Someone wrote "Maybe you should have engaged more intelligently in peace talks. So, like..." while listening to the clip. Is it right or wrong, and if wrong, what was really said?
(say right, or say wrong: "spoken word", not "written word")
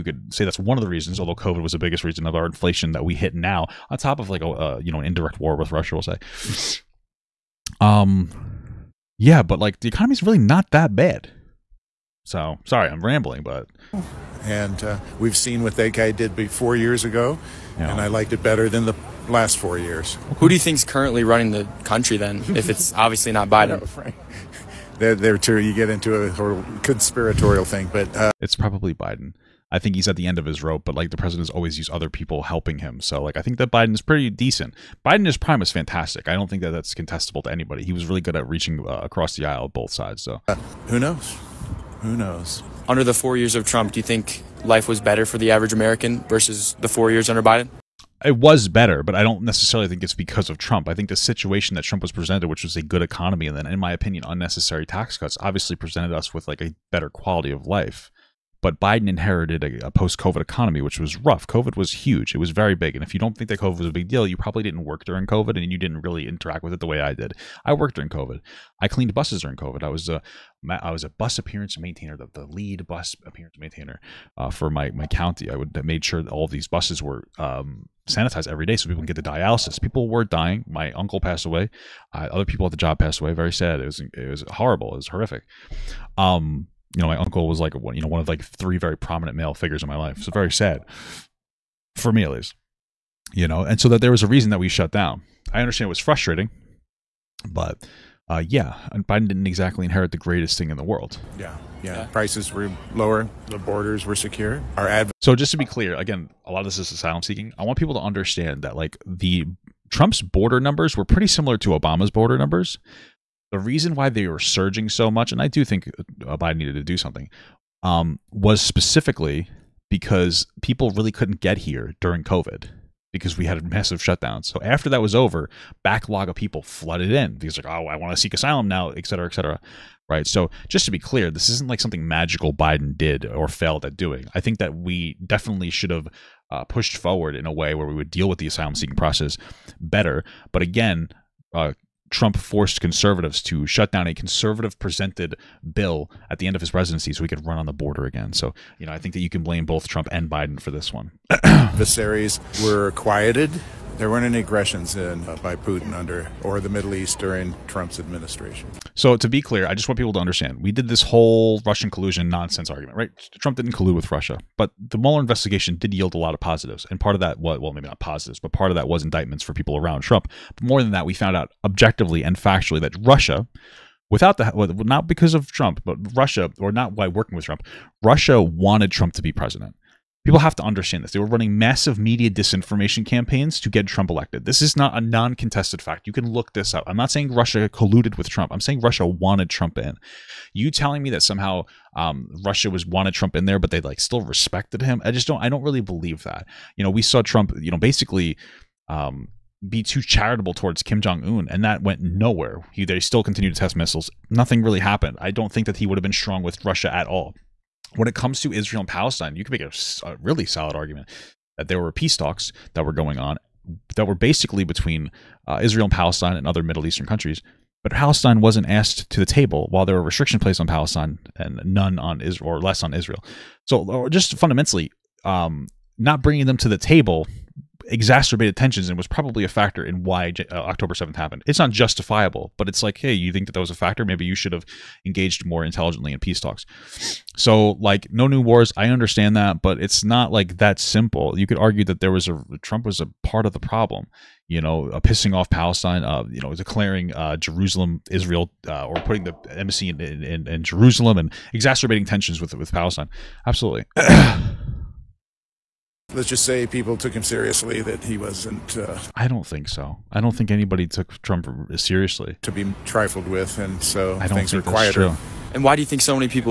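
right.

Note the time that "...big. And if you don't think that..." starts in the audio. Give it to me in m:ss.
1:02.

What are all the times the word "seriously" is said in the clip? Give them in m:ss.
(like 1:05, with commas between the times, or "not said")
4:17, 4:21.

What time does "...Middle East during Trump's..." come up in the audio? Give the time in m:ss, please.
2:36.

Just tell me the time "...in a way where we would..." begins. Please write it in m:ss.
2:17.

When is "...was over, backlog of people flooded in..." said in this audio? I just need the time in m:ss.
2:05.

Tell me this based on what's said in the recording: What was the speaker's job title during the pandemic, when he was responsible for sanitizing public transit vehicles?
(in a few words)
lead bus appearance maintainer.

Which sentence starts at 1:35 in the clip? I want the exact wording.
I understand it was frustrating, but uh, yeah, Biden didn't exactly inherit the greatest thing in the world.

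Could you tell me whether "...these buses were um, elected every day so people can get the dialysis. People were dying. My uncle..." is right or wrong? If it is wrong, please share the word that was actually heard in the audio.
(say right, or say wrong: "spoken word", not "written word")
wrong: "sanitized", not "elected".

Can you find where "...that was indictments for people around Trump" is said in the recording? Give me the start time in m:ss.
2:48.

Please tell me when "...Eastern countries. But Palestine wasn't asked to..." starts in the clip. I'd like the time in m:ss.
3:36.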